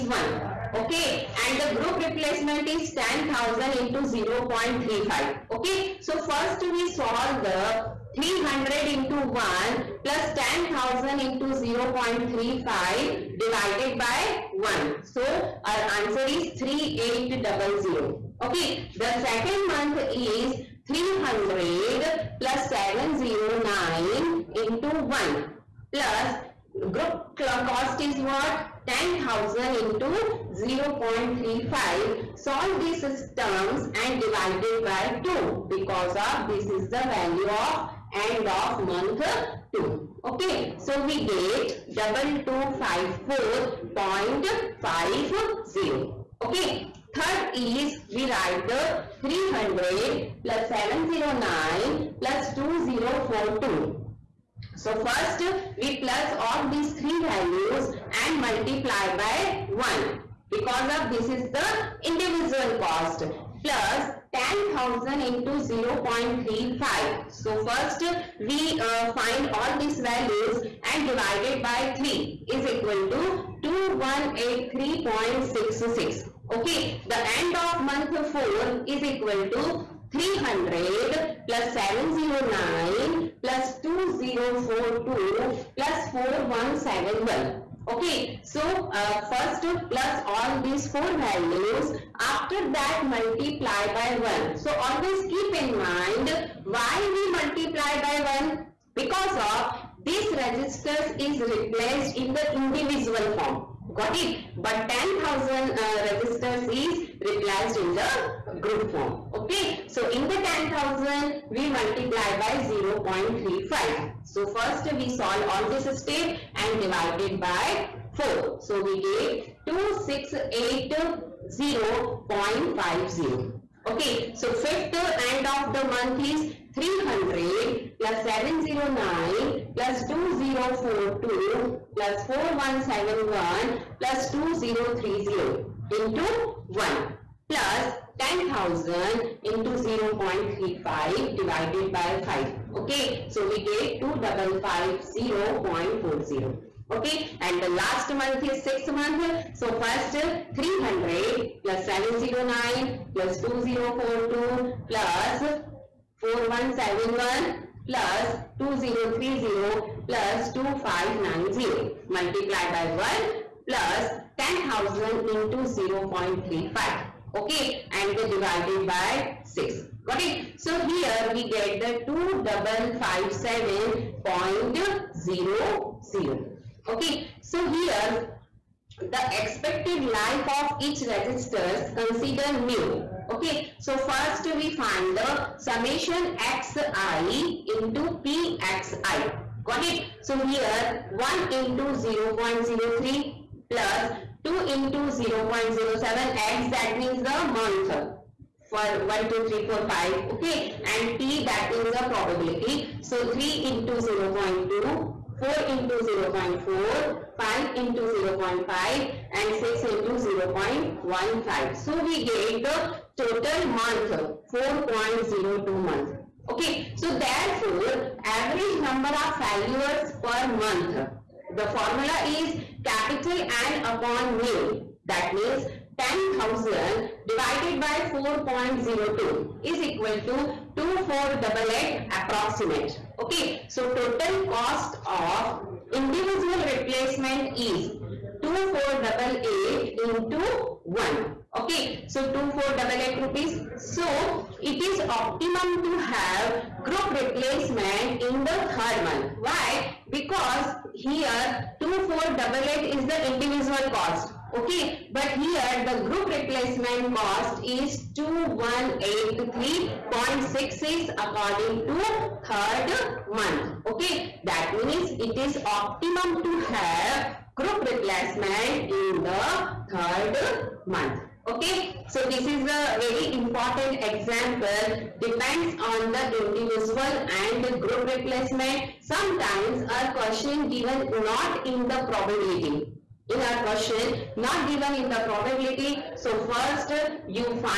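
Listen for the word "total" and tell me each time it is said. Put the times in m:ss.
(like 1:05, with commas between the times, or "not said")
3:33, 3:53.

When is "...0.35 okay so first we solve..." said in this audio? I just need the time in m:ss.
0:04.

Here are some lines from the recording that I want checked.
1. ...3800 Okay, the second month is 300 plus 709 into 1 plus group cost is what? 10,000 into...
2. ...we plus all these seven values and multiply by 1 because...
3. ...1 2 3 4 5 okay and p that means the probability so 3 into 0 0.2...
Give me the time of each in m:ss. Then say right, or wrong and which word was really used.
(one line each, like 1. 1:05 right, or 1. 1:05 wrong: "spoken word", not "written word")
1. 0:16 right
2. 0:55 wrong: "three", not "seven"
3. 3:19 right.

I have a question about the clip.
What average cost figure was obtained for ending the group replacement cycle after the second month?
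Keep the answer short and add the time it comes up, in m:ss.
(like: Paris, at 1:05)
2254.50, at 0:41.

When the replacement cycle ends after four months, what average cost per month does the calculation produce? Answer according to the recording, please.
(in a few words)
2680.50.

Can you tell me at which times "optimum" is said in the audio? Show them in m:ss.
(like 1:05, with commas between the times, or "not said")
4:05, 4:25.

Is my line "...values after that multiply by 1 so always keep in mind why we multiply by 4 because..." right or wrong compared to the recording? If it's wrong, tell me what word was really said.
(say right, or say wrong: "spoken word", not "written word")
wrong: "1", not "4".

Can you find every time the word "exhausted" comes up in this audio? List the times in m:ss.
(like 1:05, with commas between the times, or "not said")
not said.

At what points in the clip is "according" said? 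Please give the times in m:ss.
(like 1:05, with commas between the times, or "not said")
4:21.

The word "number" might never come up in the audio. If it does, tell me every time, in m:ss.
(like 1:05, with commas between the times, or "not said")
3:38.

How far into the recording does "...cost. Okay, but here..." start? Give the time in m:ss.
4:13.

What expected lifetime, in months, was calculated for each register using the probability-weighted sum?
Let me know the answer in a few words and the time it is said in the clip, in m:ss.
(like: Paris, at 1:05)
4.02 months, at 3:34.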